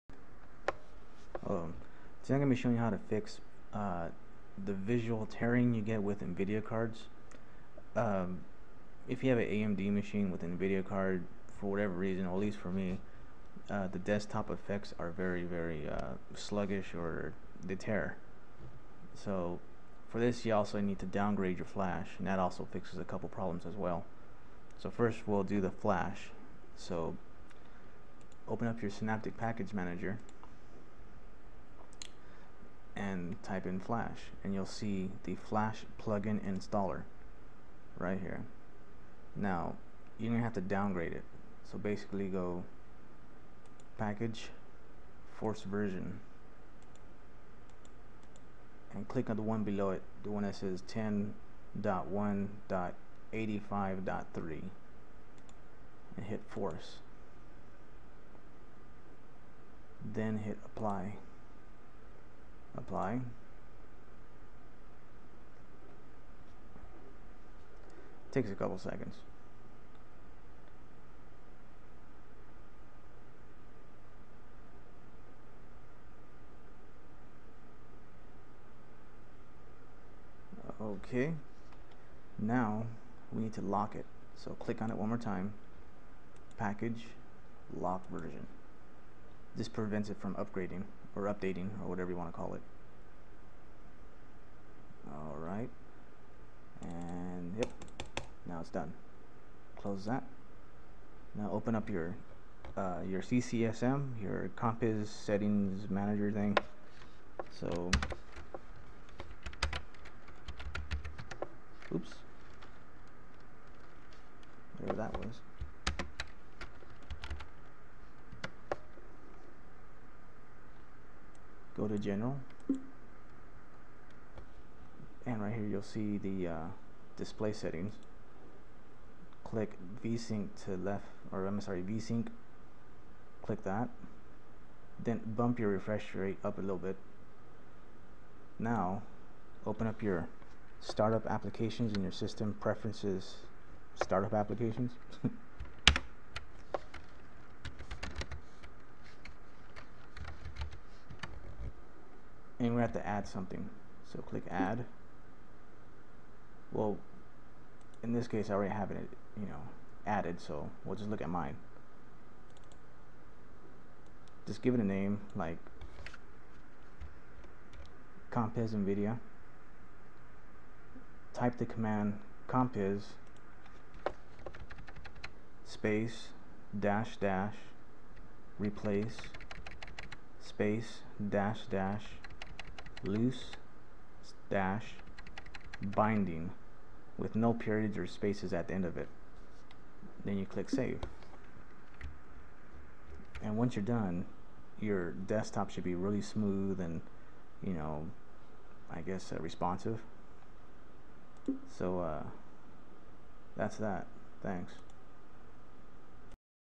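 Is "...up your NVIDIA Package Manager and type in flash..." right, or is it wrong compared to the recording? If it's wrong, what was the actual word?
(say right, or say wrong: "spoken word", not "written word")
wrong: "Synaptic", not "NVIDIA".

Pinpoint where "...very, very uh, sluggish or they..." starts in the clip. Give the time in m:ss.
0:15.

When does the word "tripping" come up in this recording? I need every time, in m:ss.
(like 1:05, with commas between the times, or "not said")
not said.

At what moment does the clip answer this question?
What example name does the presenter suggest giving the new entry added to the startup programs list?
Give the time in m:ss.
2:48.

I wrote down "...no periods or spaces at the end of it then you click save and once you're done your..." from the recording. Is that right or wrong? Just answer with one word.
right.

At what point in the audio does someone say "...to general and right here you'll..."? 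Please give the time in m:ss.
2:01.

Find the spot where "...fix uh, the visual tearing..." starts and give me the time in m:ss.
0:03.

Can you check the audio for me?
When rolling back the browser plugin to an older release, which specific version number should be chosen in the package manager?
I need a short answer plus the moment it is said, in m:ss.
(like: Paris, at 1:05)
10.1.85.3, at 0:50.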